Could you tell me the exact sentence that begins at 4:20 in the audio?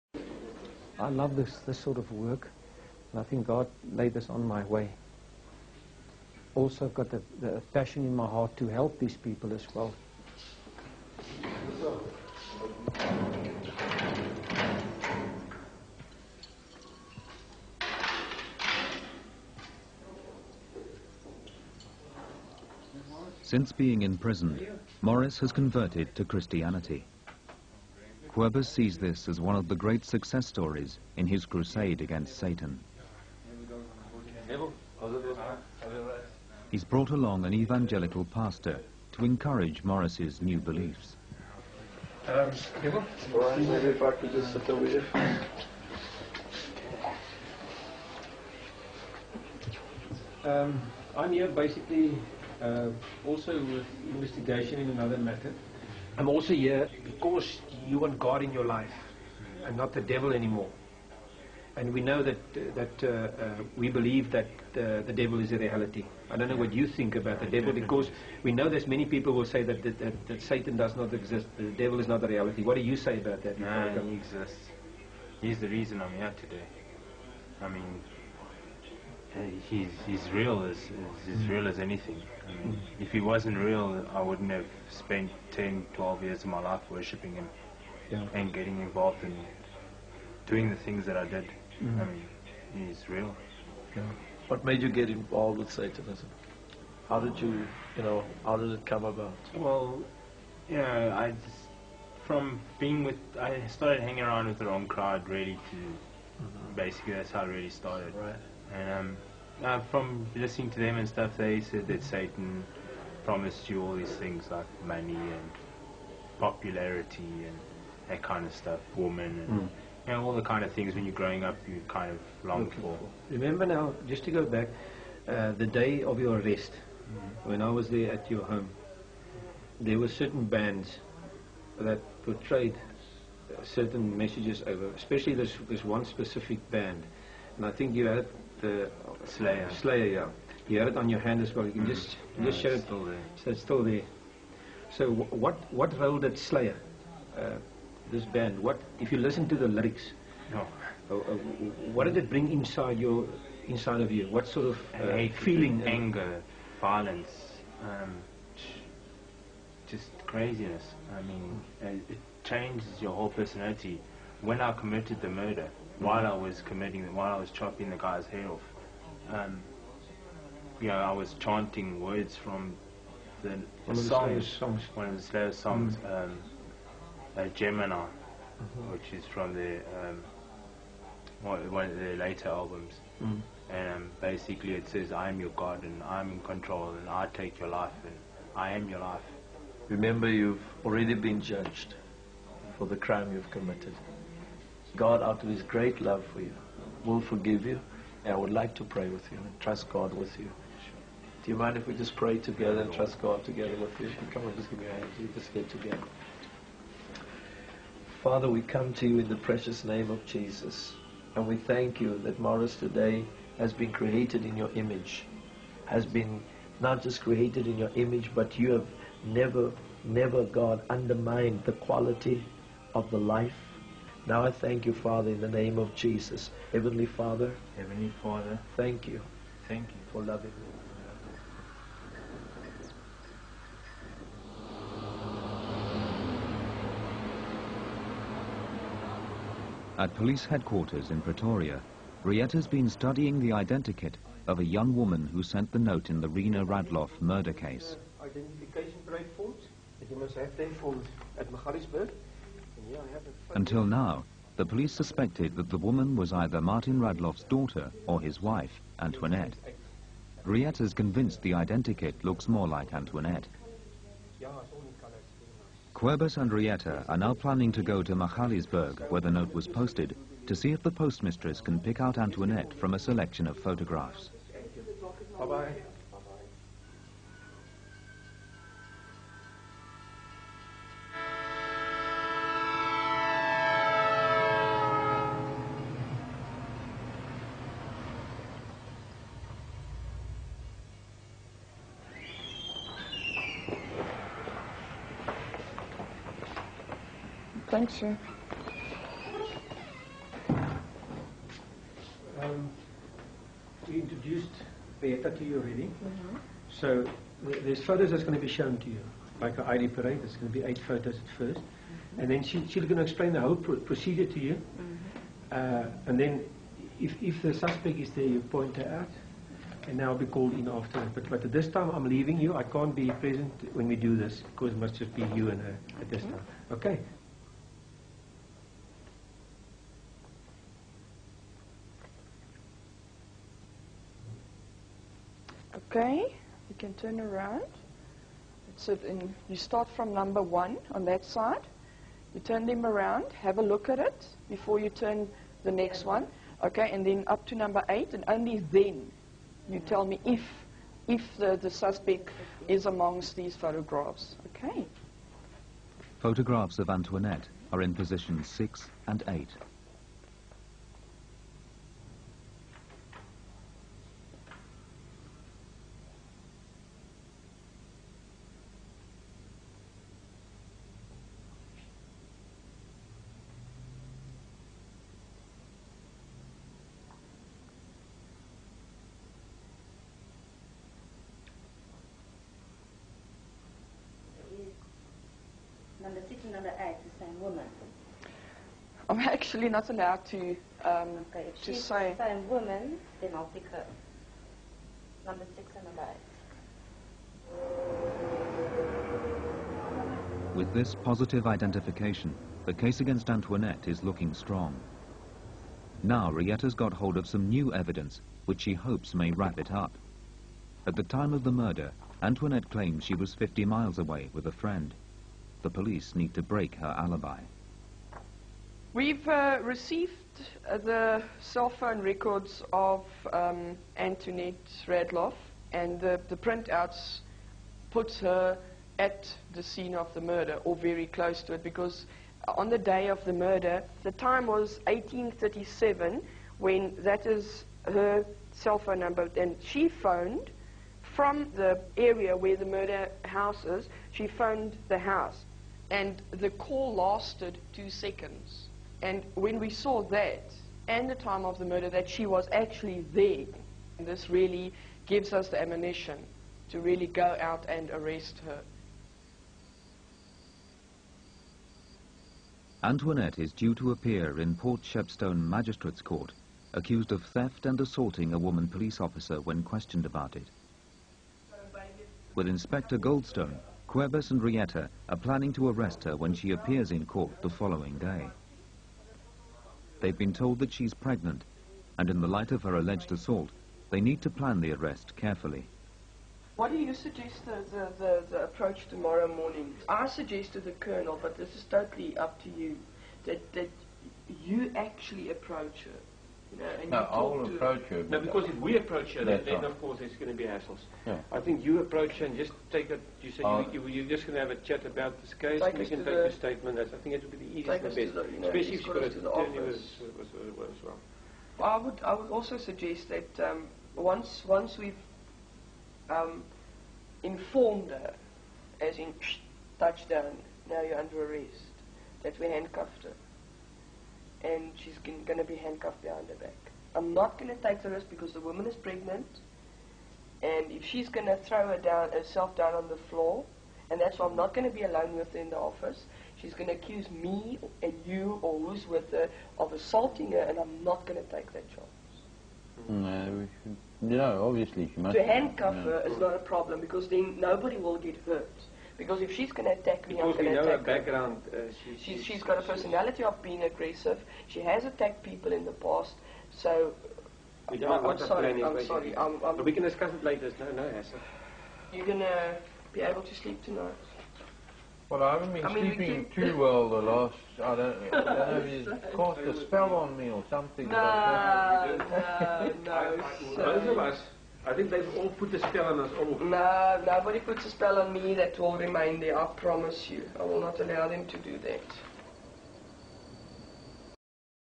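Riet is convinced the identikit looks more like Antoinette.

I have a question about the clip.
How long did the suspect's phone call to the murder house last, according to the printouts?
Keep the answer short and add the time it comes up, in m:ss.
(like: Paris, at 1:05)
2 seconds, at 7:27.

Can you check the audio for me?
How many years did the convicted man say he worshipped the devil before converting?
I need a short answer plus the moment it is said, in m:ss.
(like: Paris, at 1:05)
10, 12 years, at 1:25.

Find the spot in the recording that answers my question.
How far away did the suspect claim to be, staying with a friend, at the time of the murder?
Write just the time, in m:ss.
6:53.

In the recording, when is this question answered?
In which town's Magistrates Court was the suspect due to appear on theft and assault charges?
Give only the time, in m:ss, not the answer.
7:44.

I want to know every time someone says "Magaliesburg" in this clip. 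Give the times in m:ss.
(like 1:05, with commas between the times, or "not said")
4:11, 4:28.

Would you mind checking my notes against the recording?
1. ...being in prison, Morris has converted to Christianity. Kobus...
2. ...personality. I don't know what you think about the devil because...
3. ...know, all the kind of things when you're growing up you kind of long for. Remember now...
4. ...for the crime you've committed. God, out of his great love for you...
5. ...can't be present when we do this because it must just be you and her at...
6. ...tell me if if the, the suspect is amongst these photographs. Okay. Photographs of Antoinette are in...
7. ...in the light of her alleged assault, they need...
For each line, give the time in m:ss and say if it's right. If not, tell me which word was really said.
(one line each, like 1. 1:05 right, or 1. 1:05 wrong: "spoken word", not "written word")
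1. 0:23 right
2. 1:05 wrong: "reality", not "personality"
3. 2:00 right
4. 3:12 right
5. 5:22 right
6. 5:49 right
7. 8:02 right.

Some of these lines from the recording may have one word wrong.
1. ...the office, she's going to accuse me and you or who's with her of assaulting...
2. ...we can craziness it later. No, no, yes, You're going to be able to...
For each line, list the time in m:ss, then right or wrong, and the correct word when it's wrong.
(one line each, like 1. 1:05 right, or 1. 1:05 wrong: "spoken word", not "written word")
1. 8:55 right
2. 9:19 wrong: "discuss", not "craziness".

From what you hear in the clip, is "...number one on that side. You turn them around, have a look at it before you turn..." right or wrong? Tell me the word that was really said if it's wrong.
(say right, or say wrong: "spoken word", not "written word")
right.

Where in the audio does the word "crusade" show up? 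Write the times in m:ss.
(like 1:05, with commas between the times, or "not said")
0:31.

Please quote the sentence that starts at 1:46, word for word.
basically that's how it really started.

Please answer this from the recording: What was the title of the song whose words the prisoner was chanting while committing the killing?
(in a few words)
Gemini.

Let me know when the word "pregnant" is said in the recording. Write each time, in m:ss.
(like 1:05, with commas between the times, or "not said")
8:00, 8:48.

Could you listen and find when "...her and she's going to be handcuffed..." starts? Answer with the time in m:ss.
8:43.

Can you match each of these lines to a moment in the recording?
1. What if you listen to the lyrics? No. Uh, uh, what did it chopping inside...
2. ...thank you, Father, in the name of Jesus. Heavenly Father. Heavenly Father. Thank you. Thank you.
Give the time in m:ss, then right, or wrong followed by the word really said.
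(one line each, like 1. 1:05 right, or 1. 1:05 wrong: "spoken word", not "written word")
1. 2:28 wrong: "bring", not "chopping"
2. 3:44 right.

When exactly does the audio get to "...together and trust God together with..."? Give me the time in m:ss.
3:22.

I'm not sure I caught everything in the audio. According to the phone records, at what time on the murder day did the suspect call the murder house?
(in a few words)
1837.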